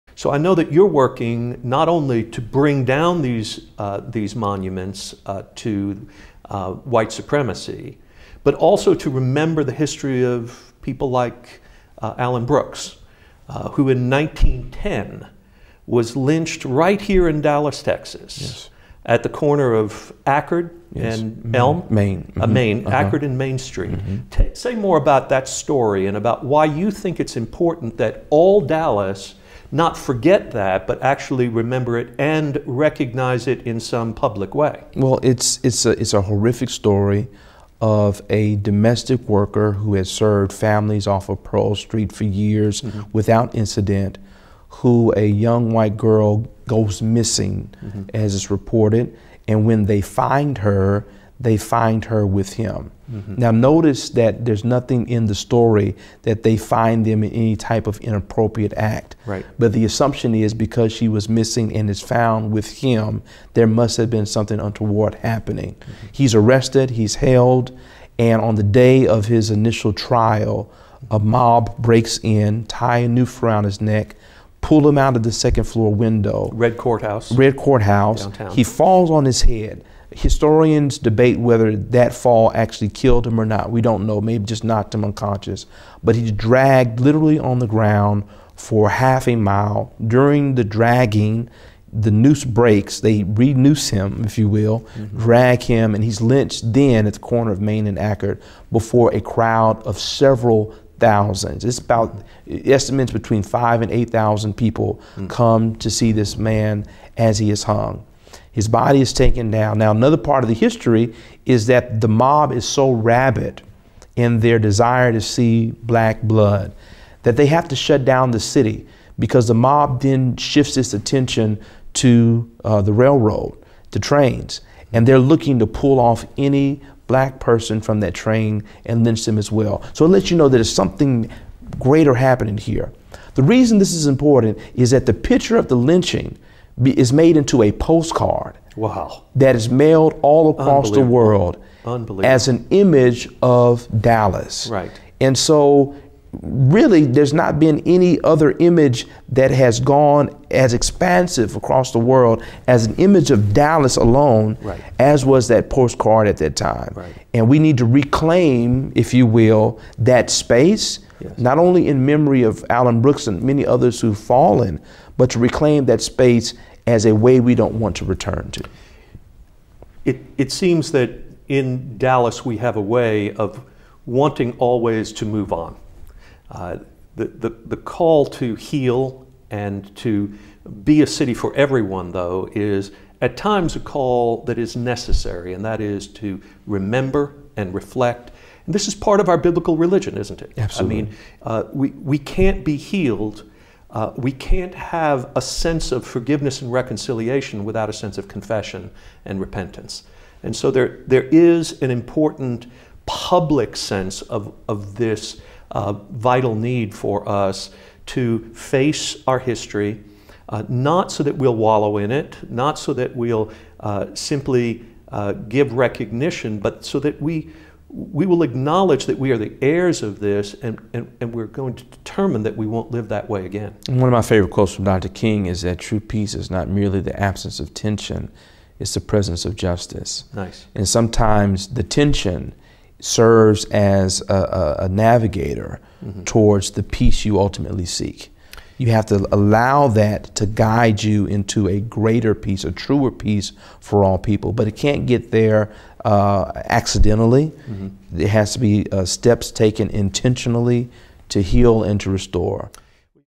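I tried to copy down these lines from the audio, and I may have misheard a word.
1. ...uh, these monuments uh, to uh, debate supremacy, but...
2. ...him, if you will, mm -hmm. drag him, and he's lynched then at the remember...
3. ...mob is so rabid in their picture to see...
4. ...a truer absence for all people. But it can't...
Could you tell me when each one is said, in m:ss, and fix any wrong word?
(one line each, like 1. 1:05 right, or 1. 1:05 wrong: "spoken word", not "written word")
1. 0:03 wrong: "white", not "debate"
2. 1:33 wrong: "corner", not "remember"
3. 1:52 wrong: "desire", not "picture"
4. 4:02 wrong: "peace", not "absence".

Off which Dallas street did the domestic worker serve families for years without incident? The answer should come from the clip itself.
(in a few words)
Pearl Street.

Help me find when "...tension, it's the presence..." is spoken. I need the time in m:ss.
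3:47.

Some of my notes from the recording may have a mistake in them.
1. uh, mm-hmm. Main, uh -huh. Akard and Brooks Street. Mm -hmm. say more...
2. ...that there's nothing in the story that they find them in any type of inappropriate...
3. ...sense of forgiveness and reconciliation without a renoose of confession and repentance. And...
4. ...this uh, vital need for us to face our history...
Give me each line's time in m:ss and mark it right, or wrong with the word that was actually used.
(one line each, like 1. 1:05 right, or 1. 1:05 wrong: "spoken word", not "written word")
1. 0:22 wrong: "Main", not "Brooks"
2. 0:54 right
3. 3:15 wrong: "sense", not "renoose"
4. 3:24 right.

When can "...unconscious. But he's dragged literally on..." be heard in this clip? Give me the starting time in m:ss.
1:25.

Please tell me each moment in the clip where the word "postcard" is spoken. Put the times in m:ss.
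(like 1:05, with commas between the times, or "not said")
2:17, 2:35.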